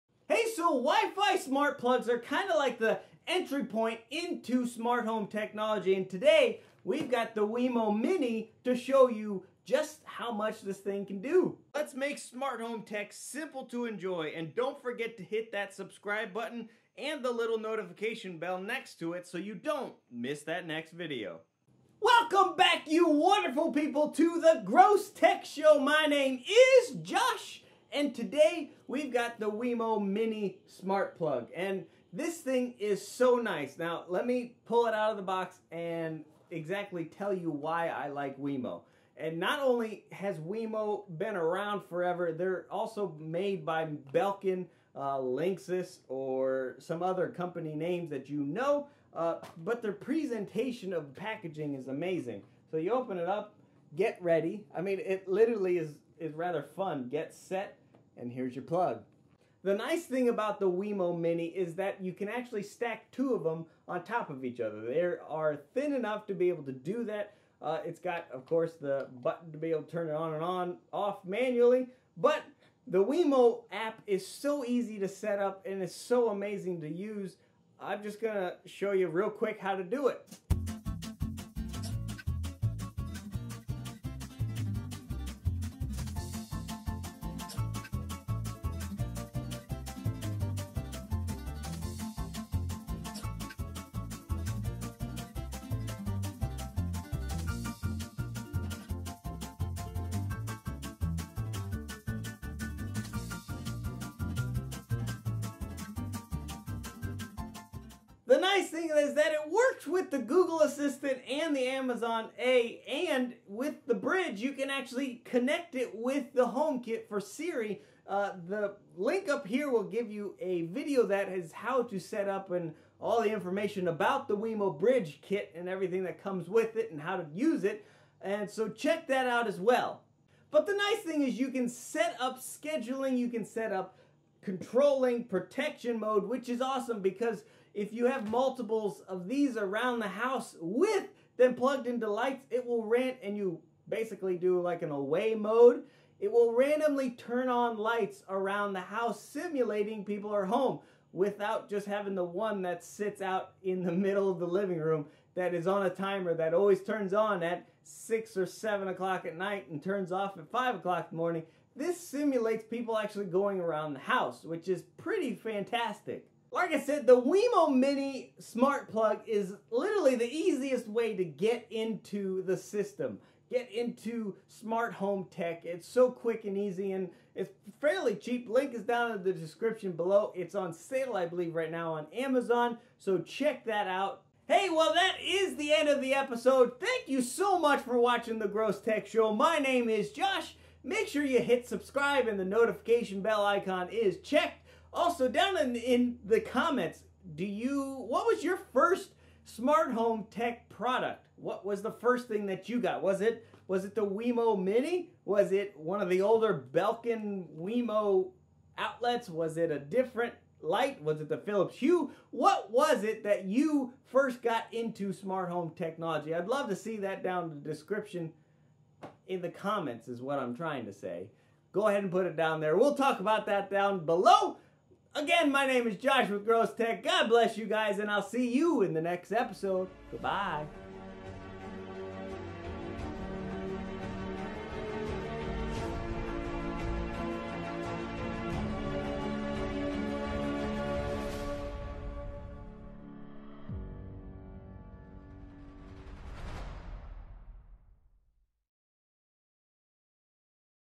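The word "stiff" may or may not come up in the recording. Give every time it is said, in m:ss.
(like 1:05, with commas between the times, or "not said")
not said.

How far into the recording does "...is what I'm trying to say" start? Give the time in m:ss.
3:40.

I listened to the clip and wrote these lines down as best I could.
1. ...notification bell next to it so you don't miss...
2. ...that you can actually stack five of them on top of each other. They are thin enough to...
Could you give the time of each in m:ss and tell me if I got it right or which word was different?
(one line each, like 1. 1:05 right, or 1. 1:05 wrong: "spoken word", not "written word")
1. 0:17 right
2. 1:01 wrong: "two", not "five".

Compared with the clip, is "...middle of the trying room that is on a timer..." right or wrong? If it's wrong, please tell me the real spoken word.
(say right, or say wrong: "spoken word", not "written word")
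wrong: "living", not "trying".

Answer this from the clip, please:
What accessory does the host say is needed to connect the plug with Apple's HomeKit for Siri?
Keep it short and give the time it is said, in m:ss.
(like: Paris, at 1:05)
the bridge, at 1:53.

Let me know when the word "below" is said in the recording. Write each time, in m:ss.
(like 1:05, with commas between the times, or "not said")
2:59, 3:44.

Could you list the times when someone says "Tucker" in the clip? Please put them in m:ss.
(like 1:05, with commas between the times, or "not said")
not said.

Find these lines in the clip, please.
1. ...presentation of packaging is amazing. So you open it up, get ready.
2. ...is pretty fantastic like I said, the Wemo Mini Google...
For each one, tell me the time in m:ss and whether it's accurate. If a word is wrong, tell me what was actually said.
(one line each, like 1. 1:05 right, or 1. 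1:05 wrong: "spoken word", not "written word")
1. 0:49 right
2. 2:44 wrong: "Smart", not "Google".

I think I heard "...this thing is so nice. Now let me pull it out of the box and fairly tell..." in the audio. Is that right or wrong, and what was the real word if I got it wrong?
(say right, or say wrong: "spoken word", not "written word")
wrong: "exactly", not "fairly".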